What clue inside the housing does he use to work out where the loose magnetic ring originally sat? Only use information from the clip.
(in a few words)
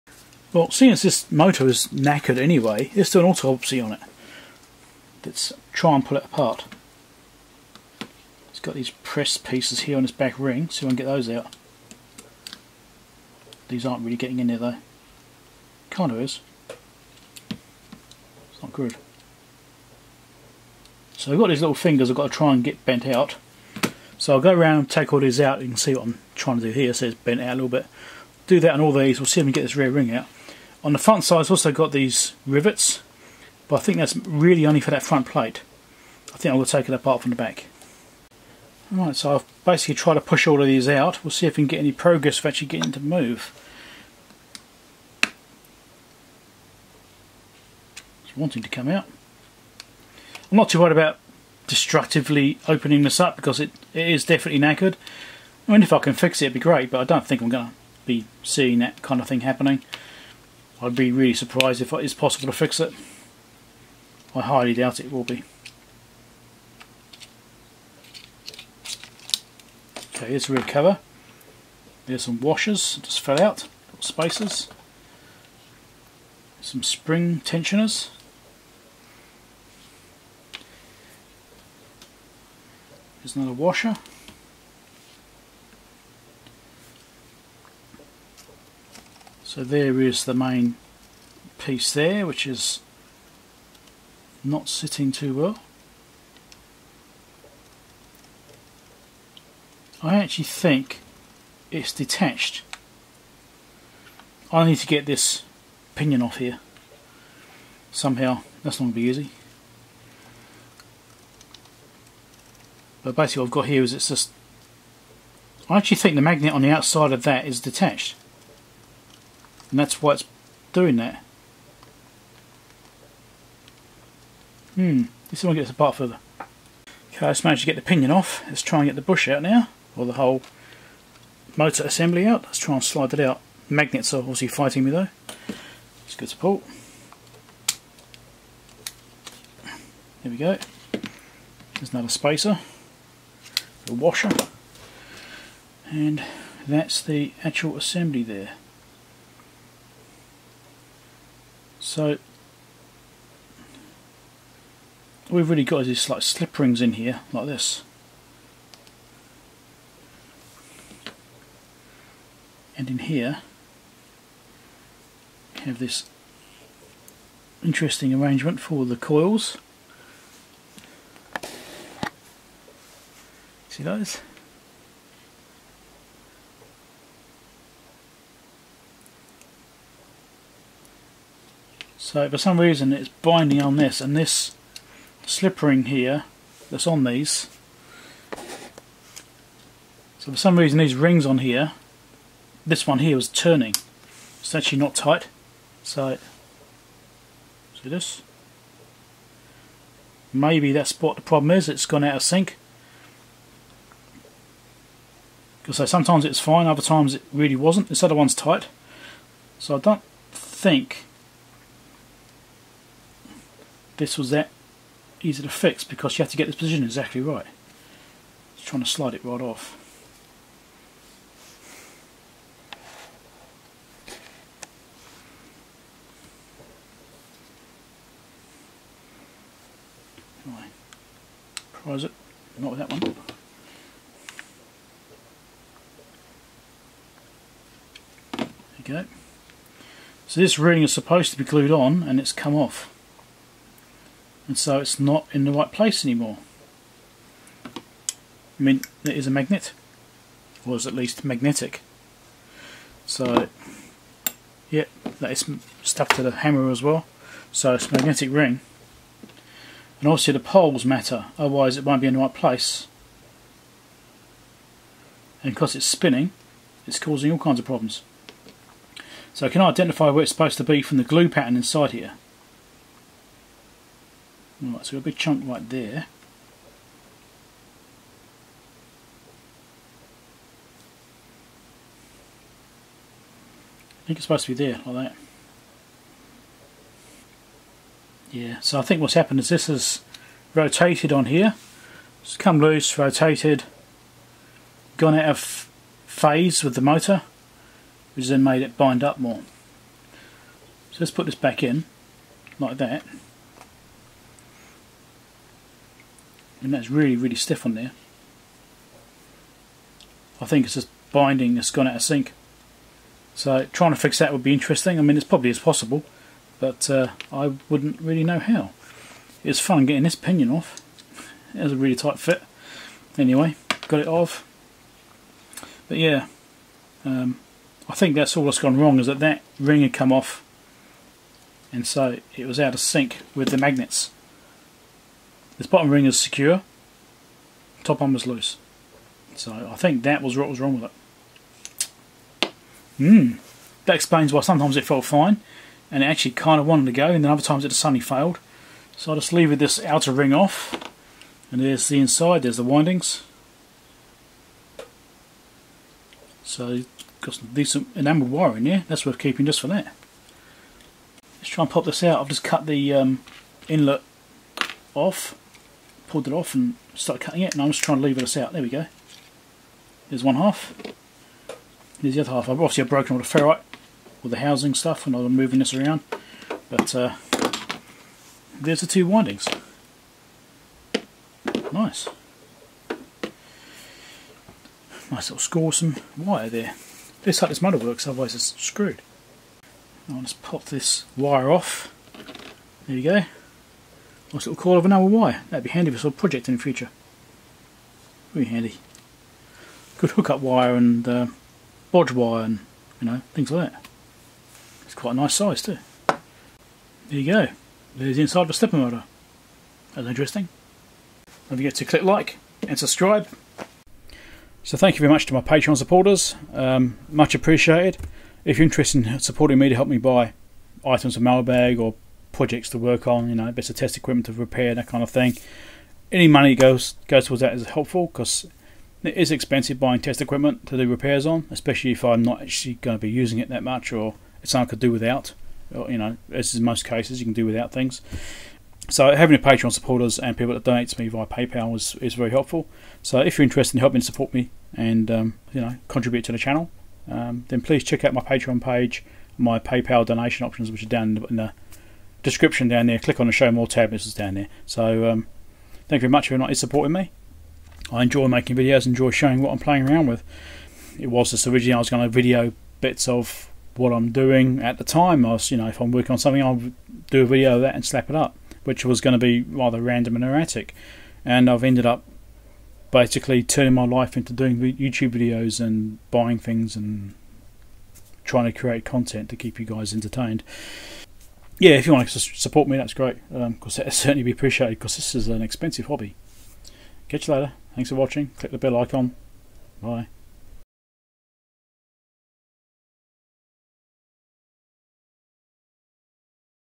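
glue pattern.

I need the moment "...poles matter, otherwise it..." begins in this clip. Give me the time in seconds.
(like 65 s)
260 s.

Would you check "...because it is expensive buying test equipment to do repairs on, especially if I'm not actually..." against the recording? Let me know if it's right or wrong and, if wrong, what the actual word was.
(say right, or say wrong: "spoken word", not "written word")
right.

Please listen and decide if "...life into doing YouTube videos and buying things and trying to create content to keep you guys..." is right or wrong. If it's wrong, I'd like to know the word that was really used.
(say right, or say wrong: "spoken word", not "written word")
right.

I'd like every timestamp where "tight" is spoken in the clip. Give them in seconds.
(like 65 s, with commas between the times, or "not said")
194 s, 208 s, 321 s.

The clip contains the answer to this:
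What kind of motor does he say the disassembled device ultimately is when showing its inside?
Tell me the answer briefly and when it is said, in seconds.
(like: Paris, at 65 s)
stepper motor, at 408 s.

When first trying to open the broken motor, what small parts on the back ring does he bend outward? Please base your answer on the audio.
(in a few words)
little fingers.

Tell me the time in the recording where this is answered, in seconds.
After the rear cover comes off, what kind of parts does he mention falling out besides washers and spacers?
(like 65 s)
76 s.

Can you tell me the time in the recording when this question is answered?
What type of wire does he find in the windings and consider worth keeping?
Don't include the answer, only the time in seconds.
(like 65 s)
357 s.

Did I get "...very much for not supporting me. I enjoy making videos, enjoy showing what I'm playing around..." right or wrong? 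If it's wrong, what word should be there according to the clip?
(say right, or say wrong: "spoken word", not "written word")
right.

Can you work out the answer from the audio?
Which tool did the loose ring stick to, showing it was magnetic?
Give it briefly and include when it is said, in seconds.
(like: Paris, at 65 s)
hammer, at 256 s.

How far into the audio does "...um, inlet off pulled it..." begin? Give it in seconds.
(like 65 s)
362 s.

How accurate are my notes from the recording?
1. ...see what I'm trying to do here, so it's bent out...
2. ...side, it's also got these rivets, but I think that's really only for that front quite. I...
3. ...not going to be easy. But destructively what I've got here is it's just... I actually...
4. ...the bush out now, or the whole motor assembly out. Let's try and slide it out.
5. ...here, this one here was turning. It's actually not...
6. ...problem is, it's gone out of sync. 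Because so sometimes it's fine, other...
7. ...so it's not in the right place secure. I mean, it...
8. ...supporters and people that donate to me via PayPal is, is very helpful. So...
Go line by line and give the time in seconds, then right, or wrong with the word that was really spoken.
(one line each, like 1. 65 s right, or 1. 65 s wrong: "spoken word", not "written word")
1. 25 s right
2. 31 s wrong: "plate", not "quite"
3. 108 s wrong: "basically", not "destructively"
4. 128 s right
5. 191 s right
6. 201 s right
7. 244 s wrong: "anymore", not "secure"
8. 439 s right.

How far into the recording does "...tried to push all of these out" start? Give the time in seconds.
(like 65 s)
39 s.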